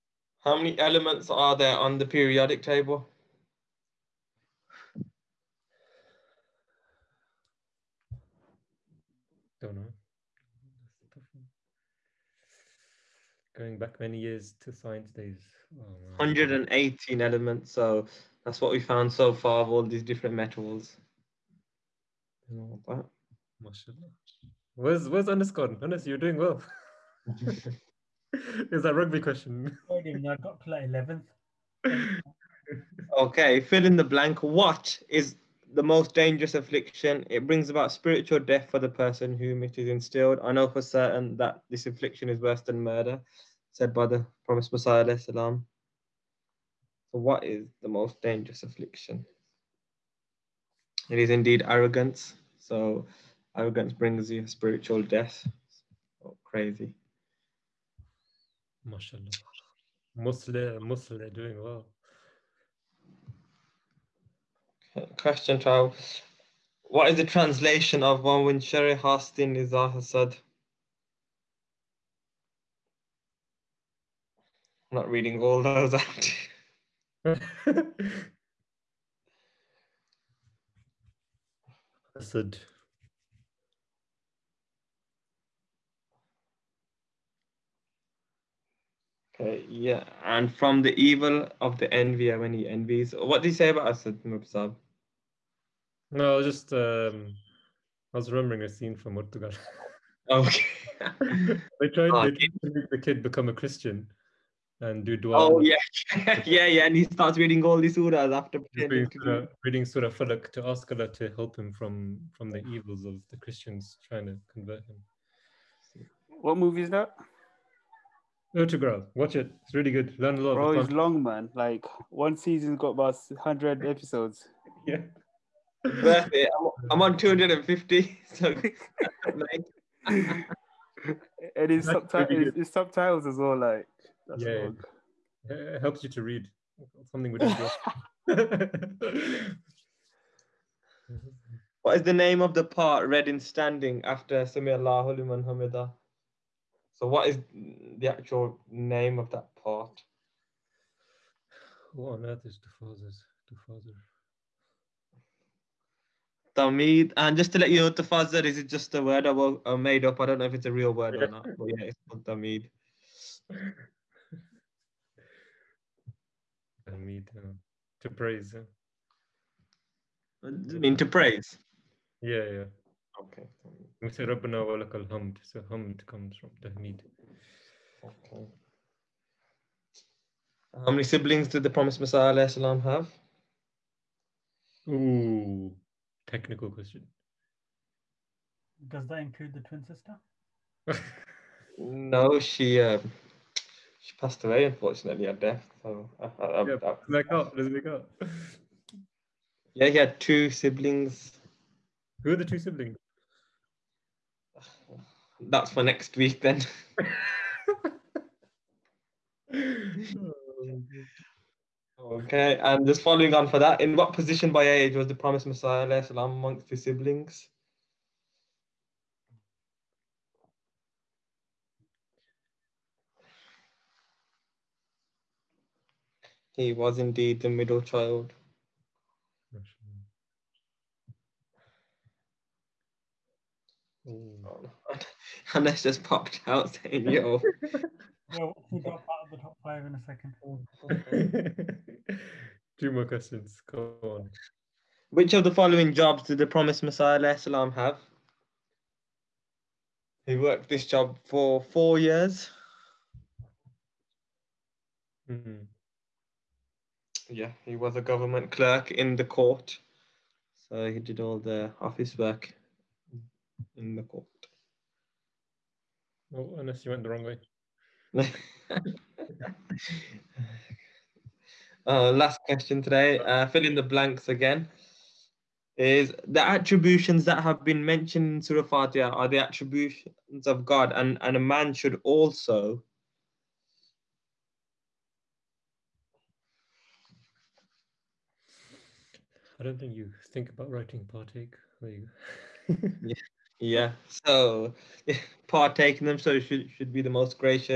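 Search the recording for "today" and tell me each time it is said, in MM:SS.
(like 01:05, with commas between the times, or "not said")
04:32.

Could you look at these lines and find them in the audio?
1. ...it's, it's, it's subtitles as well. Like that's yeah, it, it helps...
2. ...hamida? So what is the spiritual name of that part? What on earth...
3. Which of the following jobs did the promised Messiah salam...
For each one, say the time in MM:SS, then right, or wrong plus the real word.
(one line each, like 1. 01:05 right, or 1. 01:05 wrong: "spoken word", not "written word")
1. 02:11 right
2. 02:25 wrong: "actual", not "spiritual"
3. 04:05 right.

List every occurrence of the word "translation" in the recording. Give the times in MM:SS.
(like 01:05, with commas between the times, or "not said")
01:07.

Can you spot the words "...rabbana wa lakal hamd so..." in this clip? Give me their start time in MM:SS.
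02:54.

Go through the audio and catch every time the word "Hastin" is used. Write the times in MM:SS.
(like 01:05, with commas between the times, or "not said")
01:08.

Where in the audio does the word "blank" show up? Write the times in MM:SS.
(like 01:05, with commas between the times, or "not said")
00:34, 04:33.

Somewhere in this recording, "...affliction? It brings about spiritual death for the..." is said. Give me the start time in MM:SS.
00:36.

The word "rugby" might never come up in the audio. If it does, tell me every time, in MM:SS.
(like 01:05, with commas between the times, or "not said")
00:28.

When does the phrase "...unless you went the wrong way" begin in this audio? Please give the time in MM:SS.
04:26.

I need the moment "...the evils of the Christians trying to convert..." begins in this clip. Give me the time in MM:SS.
01:52.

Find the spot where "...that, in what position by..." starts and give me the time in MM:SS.
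03:33.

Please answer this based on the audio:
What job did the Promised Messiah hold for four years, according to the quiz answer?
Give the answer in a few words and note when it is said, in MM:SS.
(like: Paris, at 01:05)
Government clerk in the court, at 04:18.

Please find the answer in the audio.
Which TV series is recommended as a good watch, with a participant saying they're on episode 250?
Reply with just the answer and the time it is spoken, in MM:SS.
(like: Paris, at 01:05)
Ertugrul, at 01:58.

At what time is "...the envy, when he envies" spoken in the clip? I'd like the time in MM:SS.
01:31.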